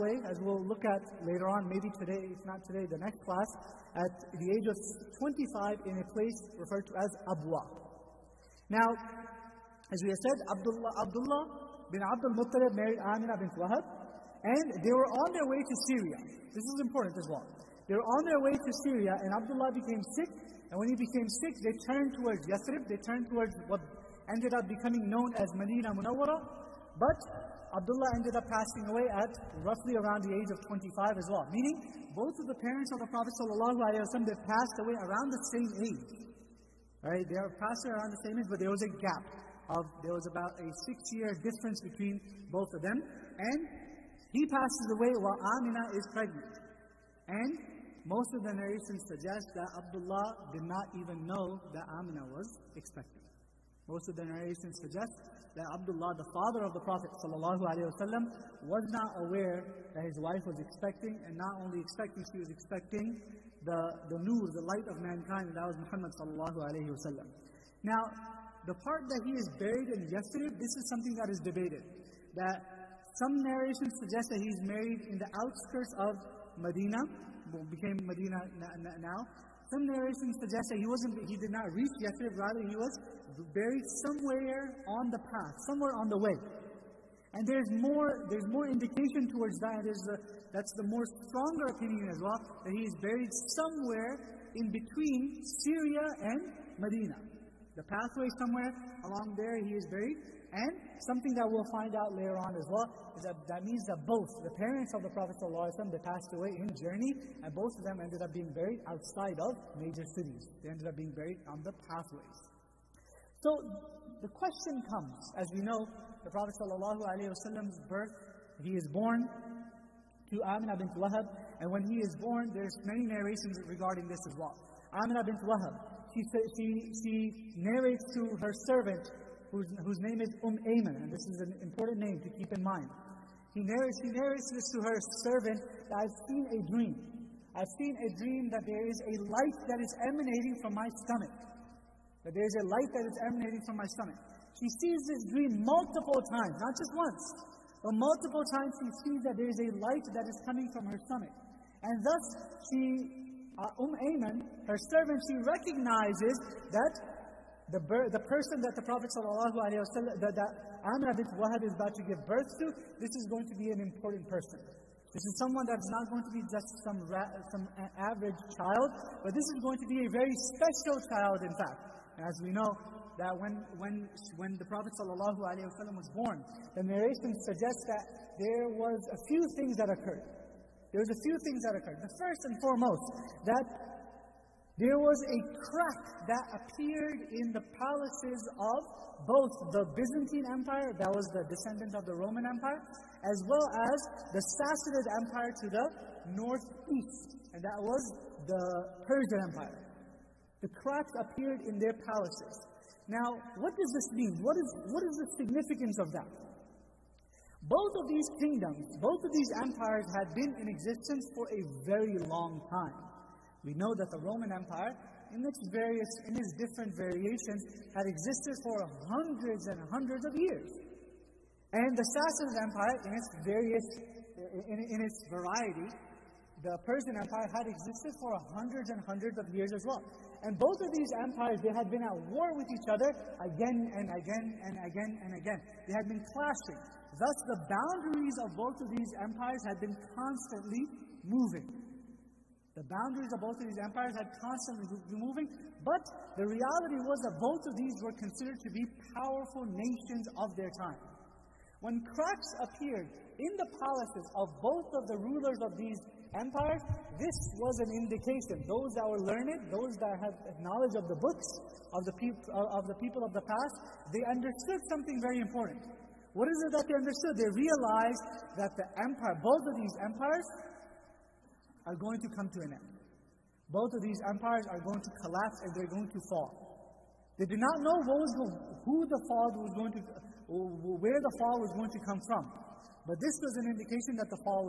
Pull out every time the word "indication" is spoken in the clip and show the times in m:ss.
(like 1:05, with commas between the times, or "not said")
1:28, 4:17, 4:43.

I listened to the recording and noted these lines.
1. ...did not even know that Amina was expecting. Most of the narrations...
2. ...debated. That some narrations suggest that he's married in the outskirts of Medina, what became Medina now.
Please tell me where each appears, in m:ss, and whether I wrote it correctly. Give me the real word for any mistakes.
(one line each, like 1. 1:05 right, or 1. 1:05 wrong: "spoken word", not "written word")
1. 0:50 right
2. 1:11 right.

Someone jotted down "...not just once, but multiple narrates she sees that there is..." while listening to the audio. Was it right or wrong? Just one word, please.
wrong.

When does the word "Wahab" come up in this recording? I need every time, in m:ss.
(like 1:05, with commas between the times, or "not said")
0:13, 2:00, 2:05, 2:41.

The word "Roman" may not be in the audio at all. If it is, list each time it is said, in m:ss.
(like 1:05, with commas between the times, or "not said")
3:12, 3:34.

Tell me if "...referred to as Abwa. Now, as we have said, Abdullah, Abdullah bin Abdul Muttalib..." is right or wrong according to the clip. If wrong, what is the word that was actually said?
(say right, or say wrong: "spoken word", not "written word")
right.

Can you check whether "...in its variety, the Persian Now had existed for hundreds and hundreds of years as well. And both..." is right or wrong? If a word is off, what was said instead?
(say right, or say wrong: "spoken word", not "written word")
wrong: "Empire", not "Now".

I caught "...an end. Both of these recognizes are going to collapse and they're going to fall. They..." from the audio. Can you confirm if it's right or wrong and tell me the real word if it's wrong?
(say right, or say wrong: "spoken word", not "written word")
wrong: "empires", not "recognizes".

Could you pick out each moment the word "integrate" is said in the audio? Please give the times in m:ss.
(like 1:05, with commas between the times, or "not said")
not said.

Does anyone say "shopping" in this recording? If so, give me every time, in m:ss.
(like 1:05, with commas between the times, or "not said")
not said.